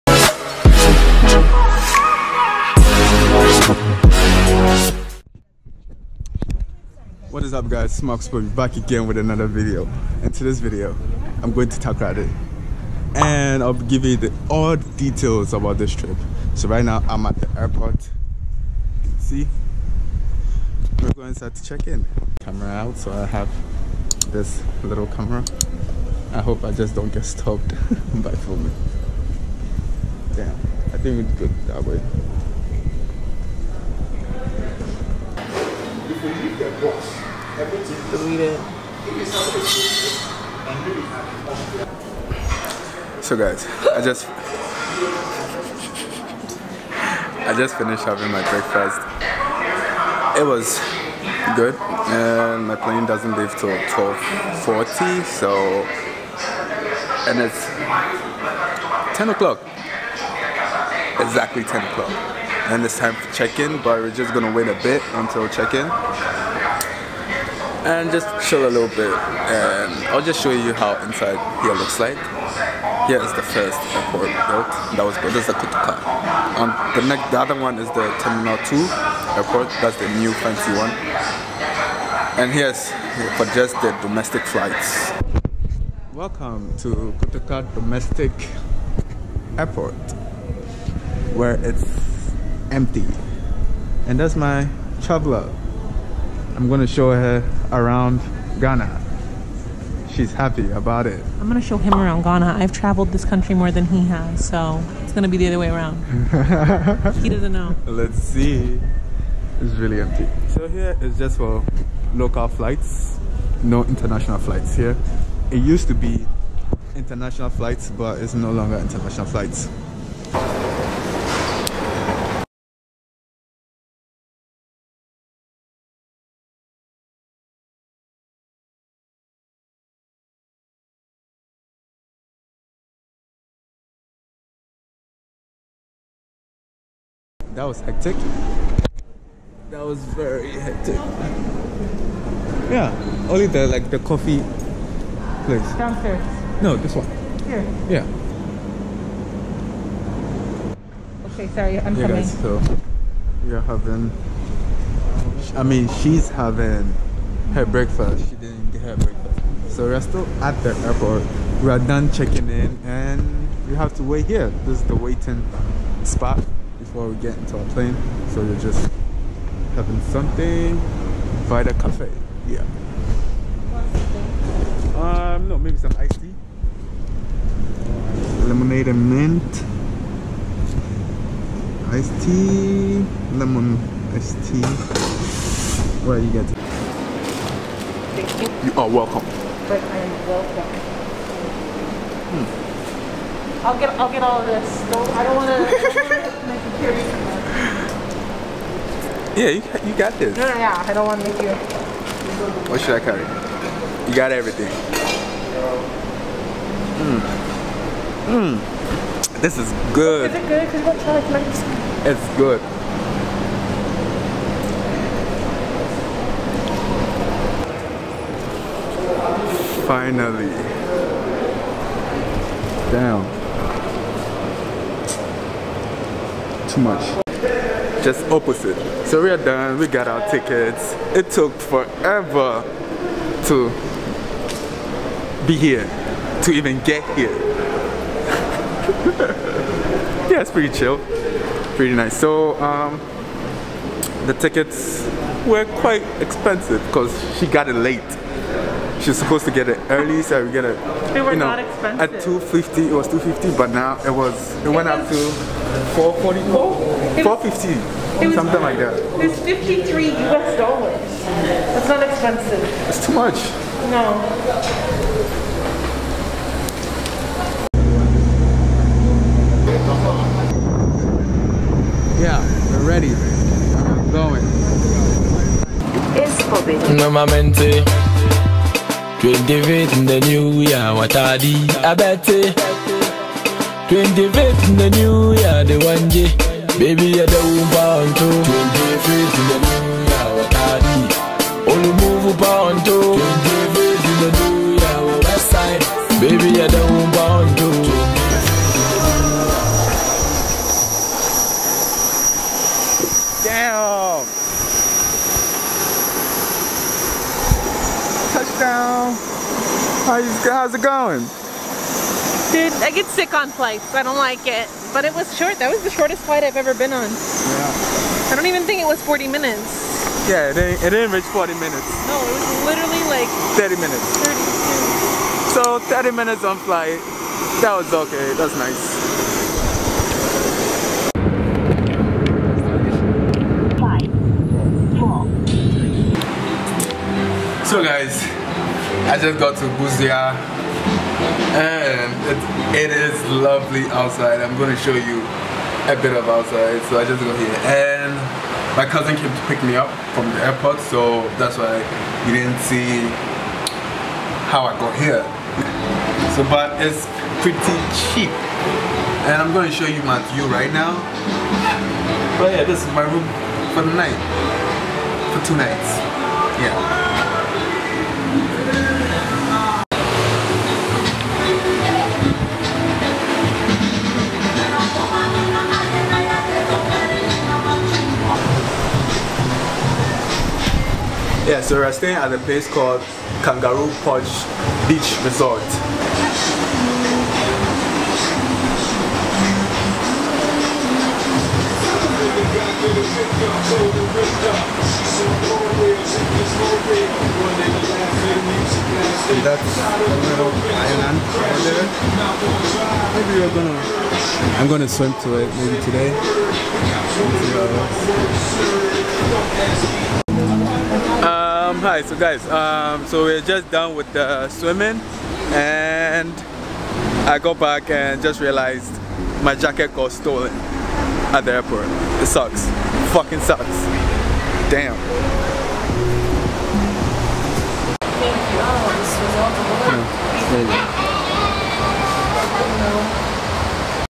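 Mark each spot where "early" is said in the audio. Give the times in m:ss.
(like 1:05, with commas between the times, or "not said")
4:09.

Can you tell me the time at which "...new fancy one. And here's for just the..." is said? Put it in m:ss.
1:20.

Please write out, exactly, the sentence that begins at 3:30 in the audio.
Because what kind of It's good.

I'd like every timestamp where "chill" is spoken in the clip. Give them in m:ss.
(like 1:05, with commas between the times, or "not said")
1:08, 4:00.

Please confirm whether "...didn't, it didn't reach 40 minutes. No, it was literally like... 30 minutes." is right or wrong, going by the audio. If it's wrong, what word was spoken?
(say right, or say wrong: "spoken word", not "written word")
right.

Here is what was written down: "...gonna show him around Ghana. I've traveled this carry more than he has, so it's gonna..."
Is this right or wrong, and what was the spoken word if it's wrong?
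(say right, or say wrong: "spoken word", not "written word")
wrong: "country", not "carry".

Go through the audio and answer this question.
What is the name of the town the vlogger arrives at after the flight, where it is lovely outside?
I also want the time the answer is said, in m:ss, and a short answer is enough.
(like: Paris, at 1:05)
Busua, at 5:39.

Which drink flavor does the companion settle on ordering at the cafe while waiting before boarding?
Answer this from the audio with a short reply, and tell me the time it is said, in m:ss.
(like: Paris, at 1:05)
Lemon iced tea, at 3:03.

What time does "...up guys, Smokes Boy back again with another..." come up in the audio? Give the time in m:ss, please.
0:07.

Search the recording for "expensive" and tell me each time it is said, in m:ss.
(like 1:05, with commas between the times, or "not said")
4:06, 4:11, 4:22.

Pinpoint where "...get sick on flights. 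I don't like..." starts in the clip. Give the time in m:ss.
5:12.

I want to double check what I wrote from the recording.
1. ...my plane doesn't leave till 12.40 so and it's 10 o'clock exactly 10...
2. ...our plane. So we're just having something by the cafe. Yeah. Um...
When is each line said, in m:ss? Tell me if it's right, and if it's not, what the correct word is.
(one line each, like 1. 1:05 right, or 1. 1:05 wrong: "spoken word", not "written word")
1. 0:52 right
2. 2:47 right.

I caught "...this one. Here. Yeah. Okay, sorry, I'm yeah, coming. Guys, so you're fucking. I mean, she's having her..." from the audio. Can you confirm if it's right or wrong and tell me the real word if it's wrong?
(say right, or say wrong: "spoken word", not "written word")
wrong: "having", not "fucking".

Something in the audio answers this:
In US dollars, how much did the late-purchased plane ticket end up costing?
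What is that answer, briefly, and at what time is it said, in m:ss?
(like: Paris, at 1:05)
53, at 4:19.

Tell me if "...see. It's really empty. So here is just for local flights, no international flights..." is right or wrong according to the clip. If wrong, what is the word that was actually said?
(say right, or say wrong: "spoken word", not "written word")
right.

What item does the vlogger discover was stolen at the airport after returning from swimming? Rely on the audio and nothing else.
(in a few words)
Jacket.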